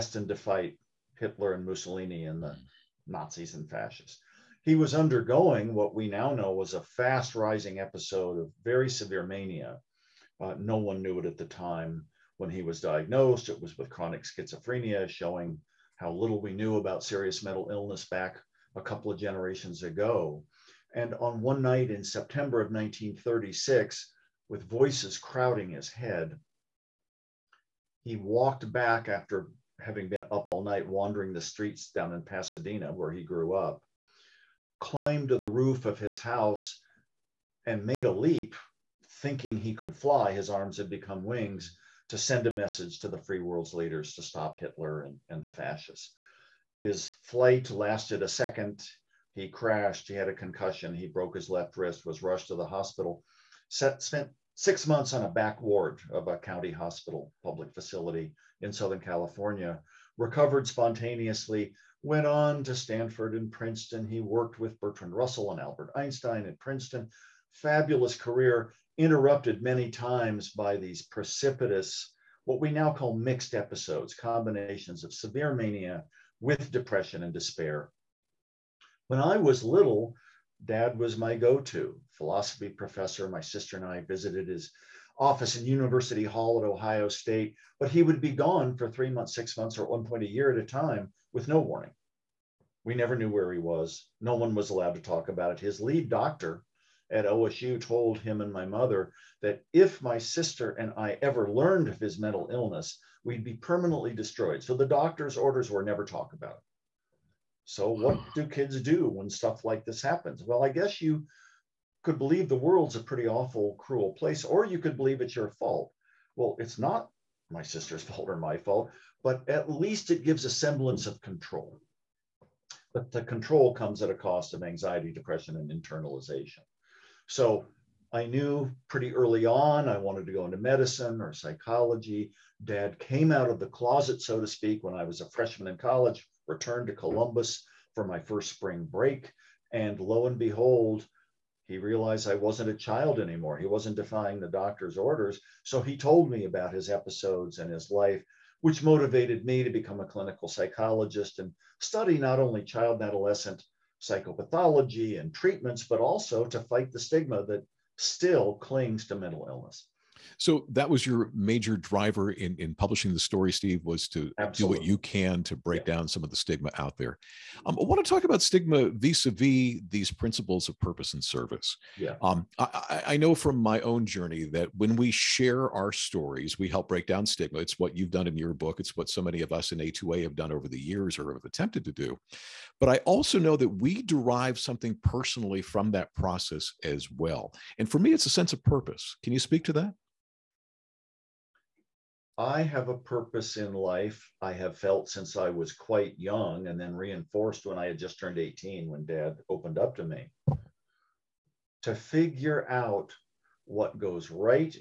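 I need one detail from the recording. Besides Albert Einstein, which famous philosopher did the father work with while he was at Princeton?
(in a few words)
Bertrand Russell.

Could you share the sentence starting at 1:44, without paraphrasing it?
So the doctor's orders were never talk about.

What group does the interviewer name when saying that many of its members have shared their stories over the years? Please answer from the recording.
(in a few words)
A2A.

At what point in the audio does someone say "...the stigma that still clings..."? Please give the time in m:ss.
2:36.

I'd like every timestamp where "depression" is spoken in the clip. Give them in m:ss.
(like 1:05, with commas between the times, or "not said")
1:16, 2:05.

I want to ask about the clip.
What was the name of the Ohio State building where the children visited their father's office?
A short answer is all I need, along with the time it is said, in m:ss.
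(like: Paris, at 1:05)
University Hall, at 1:25.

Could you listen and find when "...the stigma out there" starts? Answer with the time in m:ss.
2:46.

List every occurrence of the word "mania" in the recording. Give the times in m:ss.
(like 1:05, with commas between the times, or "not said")
0:09, 1:15.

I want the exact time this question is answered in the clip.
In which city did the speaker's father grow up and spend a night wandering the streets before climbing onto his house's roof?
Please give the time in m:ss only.
0:32.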